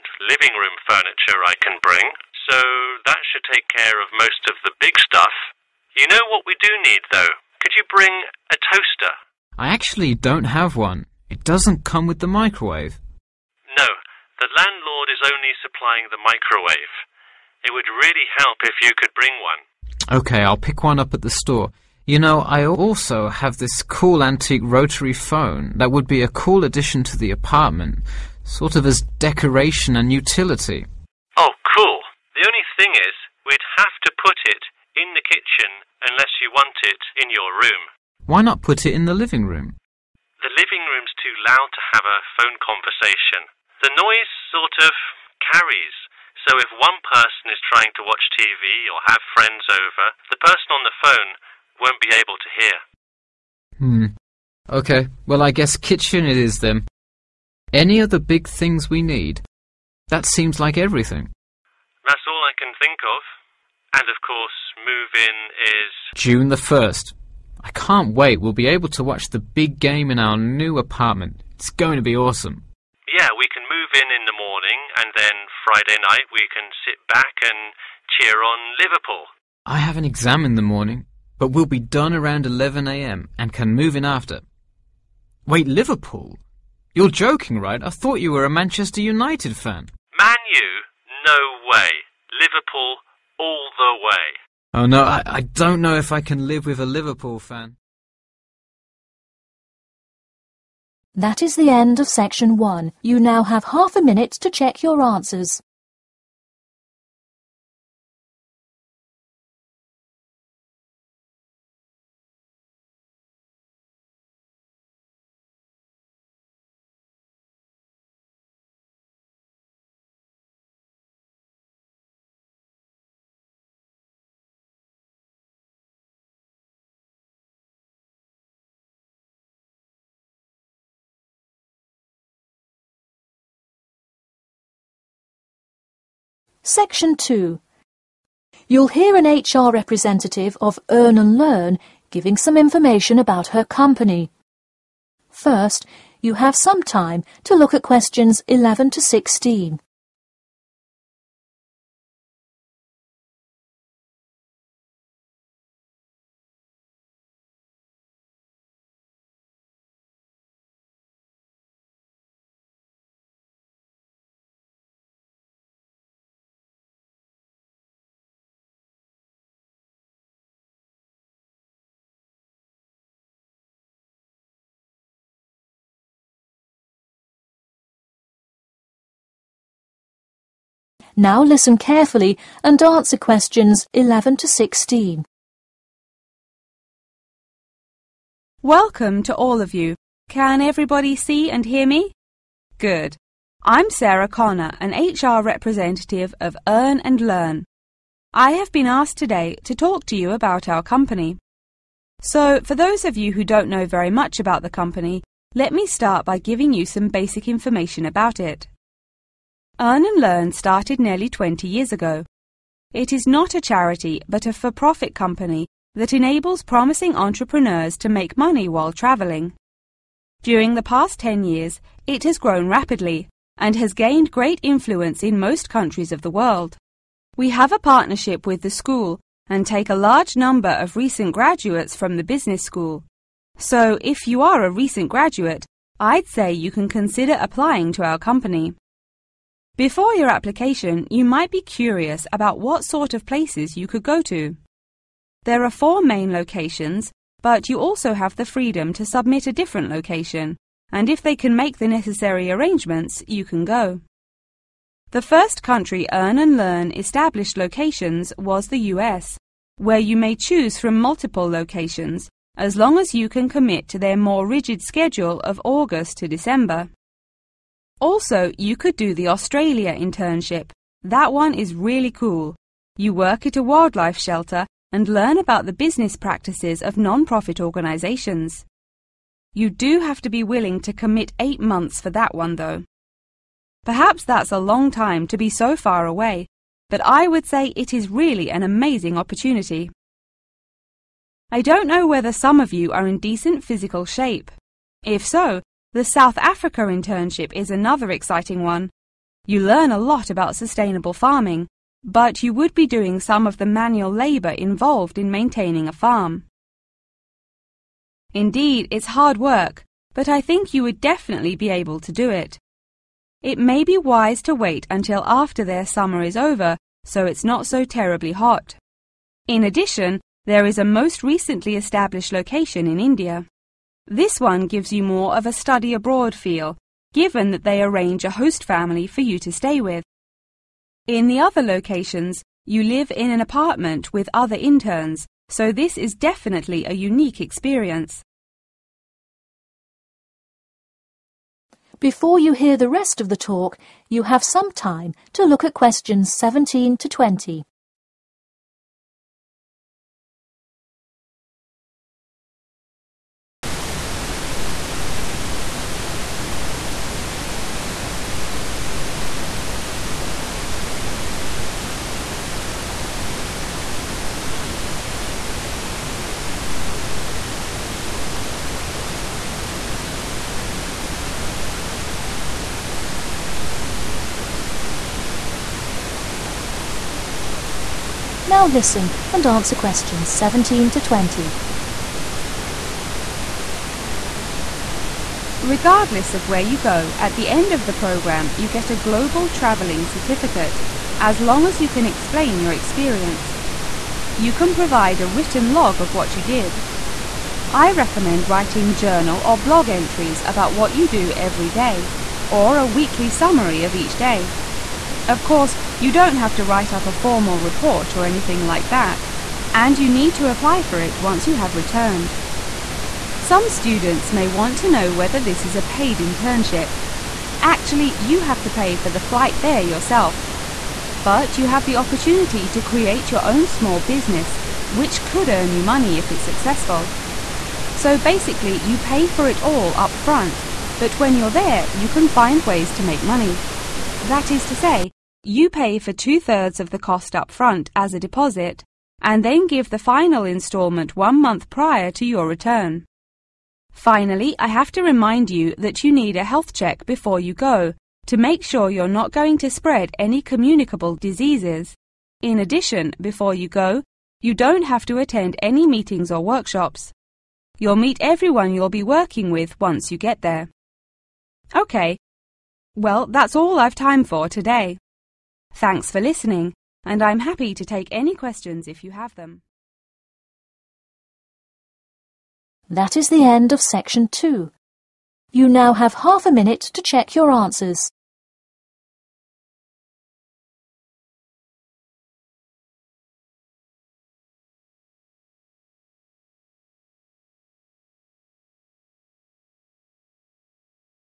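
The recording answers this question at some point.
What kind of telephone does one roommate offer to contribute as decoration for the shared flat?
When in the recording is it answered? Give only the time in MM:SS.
00:24.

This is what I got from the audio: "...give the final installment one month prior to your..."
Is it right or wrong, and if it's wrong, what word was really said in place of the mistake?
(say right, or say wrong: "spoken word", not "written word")
right.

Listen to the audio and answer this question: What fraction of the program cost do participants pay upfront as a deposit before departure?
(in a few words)
two-thirds.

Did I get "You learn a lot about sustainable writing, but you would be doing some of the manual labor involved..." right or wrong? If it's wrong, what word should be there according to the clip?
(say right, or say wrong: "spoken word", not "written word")
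wrong: "farming", not "writing".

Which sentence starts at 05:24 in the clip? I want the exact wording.
This one gives you more of a study abroad feel, given that they arrange a host family for you to stay with.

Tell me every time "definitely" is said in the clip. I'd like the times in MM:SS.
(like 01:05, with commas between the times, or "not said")
05:10, 05:36.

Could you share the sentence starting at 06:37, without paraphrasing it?
I recommend writing journal or blog entries about what you do every day, or a weekly summary of each day.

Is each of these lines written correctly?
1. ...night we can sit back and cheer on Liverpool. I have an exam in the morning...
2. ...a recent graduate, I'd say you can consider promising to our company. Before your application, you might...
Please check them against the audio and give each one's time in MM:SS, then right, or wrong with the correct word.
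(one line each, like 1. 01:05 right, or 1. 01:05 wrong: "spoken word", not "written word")
1. 01:16 right
2. 03:54 wrong: "applying", not "promising".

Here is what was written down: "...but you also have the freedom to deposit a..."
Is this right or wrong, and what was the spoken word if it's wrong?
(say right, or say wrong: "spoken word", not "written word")
wrong: "submit", not "deposit".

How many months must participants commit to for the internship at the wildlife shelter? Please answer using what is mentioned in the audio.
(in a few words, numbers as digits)
8 months.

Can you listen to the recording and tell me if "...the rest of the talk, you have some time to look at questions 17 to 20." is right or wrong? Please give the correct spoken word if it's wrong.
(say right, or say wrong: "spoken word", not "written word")
right.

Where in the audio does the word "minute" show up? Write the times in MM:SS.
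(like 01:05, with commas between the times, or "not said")
01:44, 07:56.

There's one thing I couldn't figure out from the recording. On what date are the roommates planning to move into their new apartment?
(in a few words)
June 1st.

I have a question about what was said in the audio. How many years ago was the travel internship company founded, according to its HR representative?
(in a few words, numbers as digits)
20 years.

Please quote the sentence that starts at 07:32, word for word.
In addition, before you go, you don't have to attend any meetings or workshops.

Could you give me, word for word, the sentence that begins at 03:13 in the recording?
I'm Sarah Connor, an HR representative of Earn and Learn.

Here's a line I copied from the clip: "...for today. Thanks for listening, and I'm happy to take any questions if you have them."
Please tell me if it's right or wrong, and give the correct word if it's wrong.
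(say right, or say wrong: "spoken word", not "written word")
right.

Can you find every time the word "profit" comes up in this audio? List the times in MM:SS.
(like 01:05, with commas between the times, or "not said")
03:34, 04:36.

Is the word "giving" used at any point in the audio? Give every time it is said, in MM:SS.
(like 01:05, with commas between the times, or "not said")
02:22, 03:26.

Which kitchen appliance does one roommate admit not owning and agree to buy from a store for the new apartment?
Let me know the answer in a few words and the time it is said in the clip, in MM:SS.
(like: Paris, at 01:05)
toaster, at 00:08.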